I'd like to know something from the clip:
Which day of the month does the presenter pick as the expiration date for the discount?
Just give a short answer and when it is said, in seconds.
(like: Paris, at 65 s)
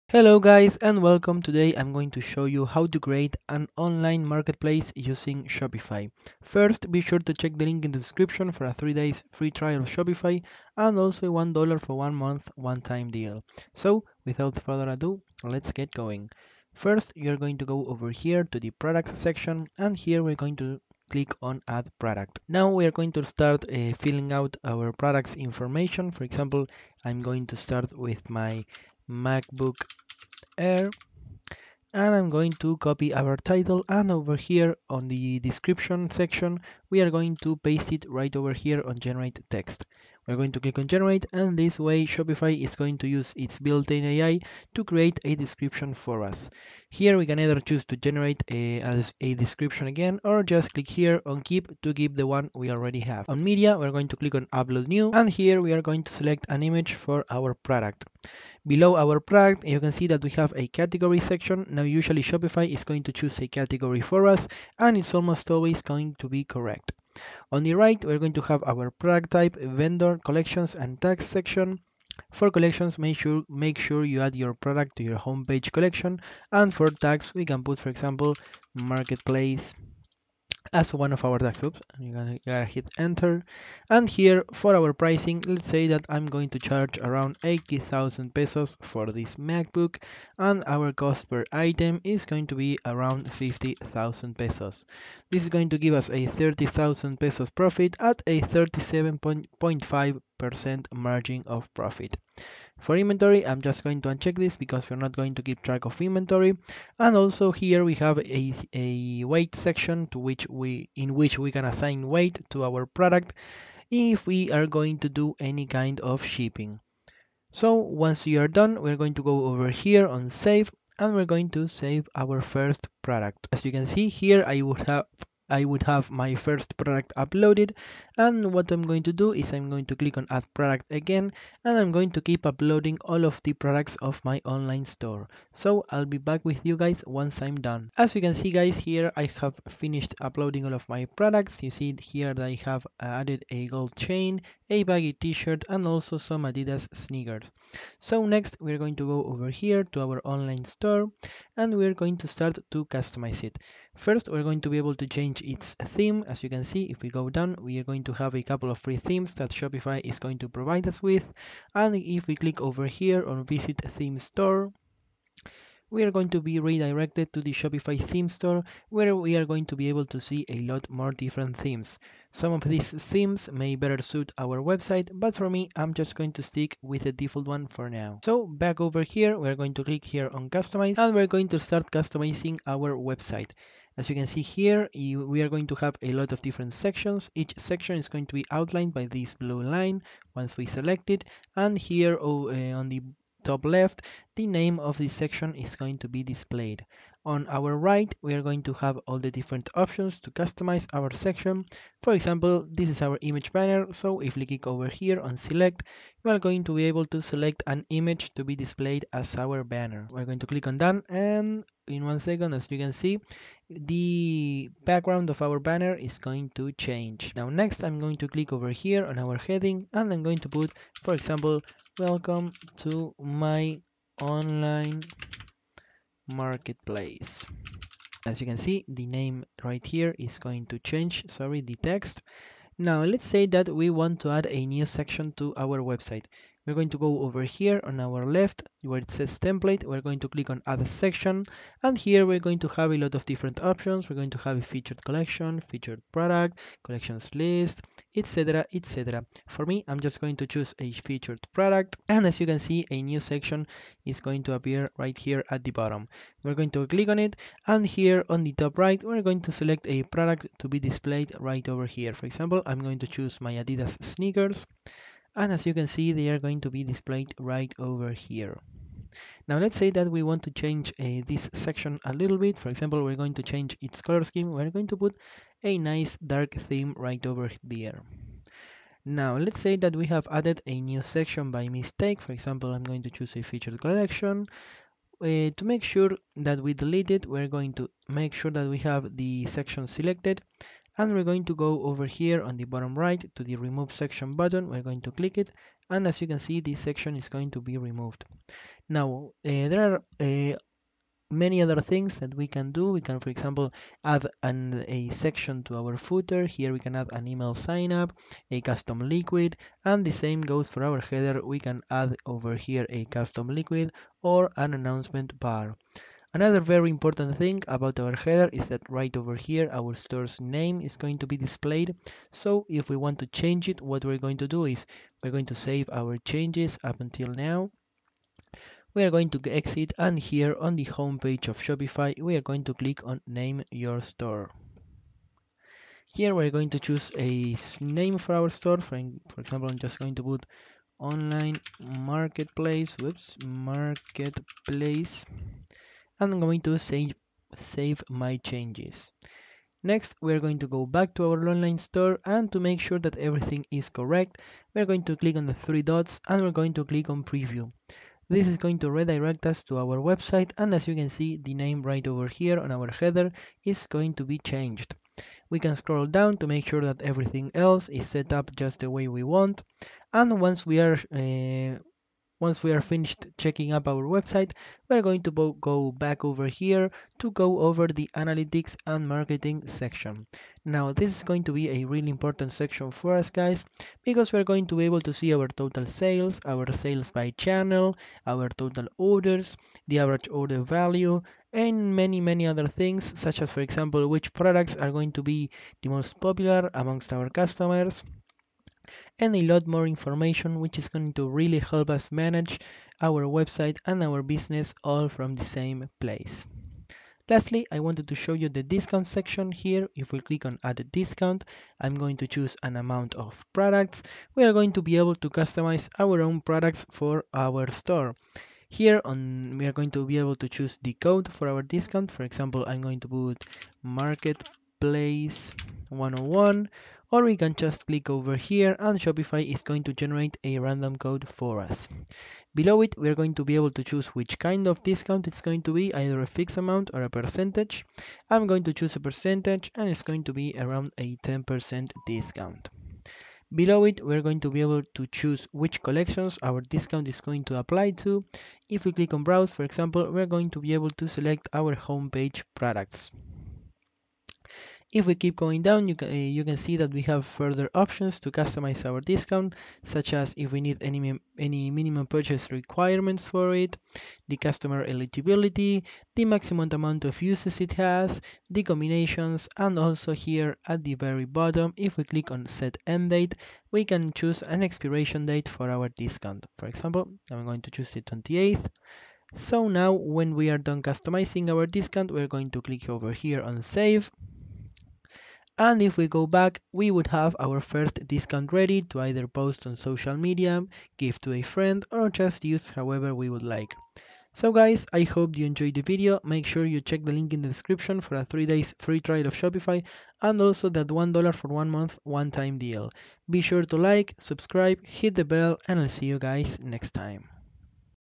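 28th, at 478 s.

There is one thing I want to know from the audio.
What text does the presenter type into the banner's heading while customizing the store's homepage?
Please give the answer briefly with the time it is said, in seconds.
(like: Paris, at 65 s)
Welcome to my online marketplace, at 222 s.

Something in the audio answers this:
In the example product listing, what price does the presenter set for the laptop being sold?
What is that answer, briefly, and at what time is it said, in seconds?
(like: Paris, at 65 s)
80,000 pesos, at 87 s.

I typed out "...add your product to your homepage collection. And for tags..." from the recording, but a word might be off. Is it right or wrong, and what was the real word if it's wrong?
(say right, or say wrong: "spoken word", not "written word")
right.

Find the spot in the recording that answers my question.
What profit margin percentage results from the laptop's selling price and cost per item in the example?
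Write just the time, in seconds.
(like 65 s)
98 s.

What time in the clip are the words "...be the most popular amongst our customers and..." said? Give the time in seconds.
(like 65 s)
395 s.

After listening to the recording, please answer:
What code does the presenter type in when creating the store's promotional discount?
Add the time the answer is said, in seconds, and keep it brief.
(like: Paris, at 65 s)
marketplace 101, at 423 s.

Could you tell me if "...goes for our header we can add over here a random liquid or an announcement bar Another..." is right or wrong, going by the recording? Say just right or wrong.
wrong.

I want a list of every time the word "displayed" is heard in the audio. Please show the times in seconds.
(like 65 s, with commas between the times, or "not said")
196 s, 208 s, 260 s, 266 s, 321 s.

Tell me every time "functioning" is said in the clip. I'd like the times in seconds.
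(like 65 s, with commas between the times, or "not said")
not said.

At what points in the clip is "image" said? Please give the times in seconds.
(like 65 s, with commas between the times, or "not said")
56 s, 203 s, 207 s.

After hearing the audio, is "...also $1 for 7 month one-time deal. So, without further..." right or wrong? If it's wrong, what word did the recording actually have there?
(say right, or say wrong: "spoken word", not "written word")
wrong: "1", not "7".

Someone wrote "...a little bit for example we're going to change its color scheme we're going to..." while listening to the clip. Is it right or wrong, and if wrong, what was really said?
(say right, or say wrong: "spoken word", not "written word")
right.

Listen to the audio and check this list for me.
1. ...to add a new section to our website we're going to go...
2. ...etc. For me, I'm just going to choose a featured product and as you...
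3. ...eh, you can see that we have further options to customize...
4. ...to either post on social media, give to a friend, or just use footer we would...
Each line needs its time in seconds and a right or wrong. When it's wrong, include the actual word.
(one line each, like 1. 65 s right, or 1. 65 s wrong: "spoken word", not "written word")
1. 234 s right
2. 248 s right
3. 456 s right
4. 488 s wrong: "however", not "footer".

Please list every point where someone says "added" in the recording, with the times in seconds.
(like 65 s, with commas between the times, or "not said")
143 s, 280 s.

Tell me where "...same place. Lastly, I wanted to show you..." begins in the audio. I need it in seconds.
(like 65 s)
405 s.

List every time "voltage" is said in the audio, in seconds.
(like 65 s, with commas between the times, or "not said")
not said.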